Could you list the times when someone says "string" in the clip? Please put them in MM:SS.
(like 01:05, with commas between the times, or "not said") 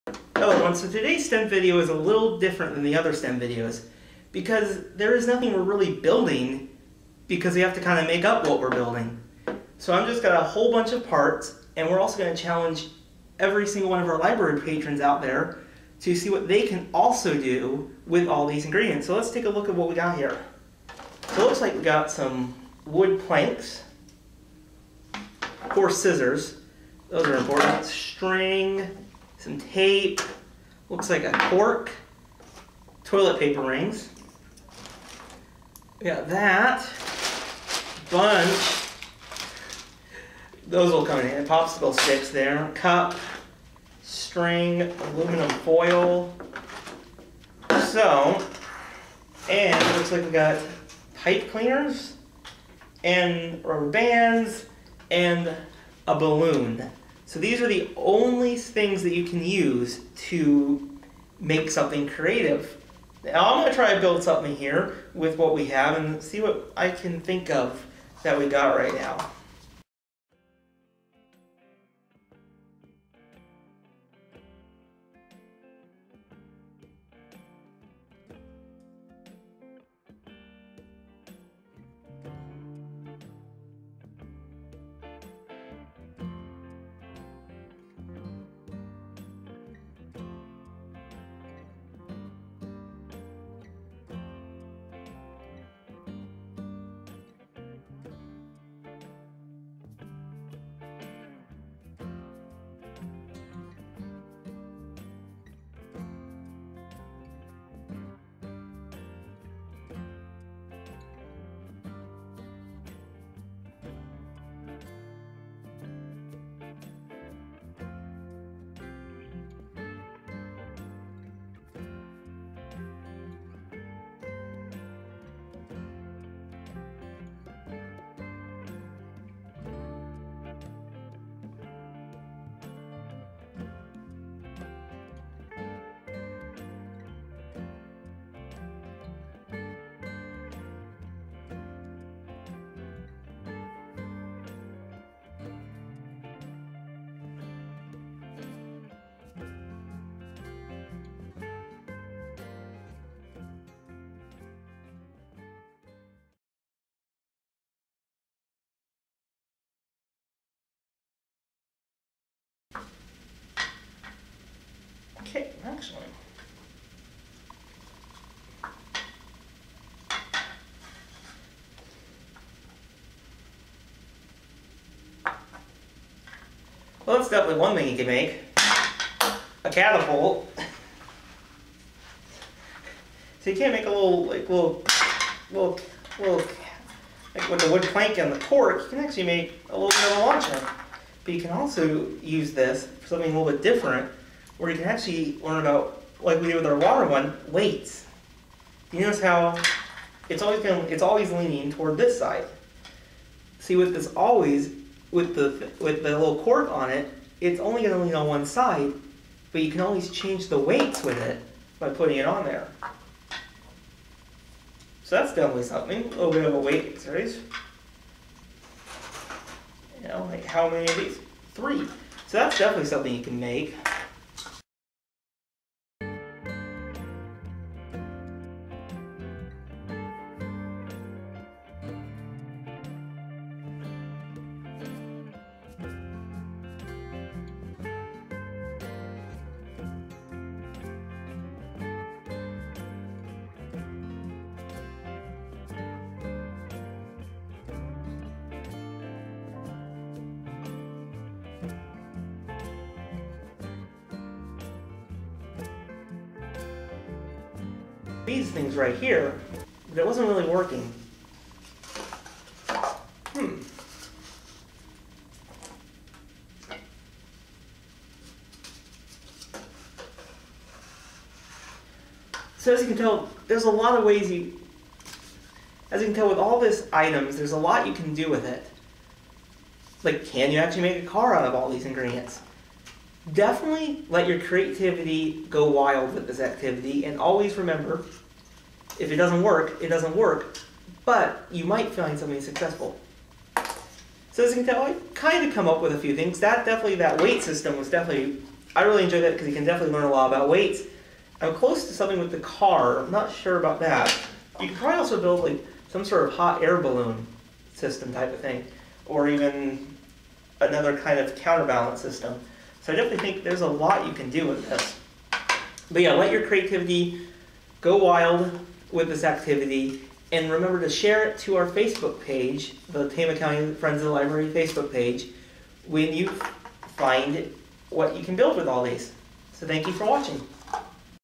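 00:27, 00:44.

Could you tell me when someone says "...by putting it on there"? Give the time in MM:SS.
03:31.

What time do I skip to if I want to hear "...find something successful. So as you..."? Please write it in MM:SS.
04:51.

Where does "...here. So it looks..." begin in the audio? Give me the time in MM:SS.
00:20.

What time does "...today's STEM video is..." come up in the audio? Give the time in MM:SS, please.
00:00.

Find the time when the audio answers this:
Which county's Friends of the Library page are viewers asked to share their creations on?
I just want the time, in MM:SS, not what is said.
05:23.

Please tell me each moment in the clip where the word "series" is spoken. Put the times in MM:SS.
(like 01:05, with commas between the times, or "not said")
03:37.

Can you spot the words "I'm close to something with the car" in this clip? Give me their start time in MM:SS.
05:01.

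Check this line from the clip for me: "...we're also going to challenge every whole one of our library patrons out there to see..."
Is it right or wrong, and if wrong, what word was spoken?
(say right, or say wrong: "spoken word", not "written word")
wrong: "single", not "whole".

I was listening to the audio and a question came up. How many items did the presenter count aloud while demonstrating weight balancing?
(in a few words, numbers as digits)
3.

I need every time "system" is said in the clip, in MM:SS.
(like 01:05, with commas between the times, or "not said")
04:57, 05:07, 05:12.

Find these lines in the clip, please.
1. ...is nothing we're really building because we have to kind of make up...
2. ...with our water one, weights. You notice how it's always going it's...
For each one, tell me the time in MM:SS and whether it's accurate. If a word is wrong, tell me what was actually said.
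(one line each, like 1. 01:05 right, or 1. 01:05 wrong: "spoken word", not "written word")
1. 00:05 right
2. 03:16 right.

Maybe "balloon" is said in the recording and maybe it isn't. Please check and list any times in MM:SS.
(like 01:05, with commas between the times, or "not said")
00:56, 05:06.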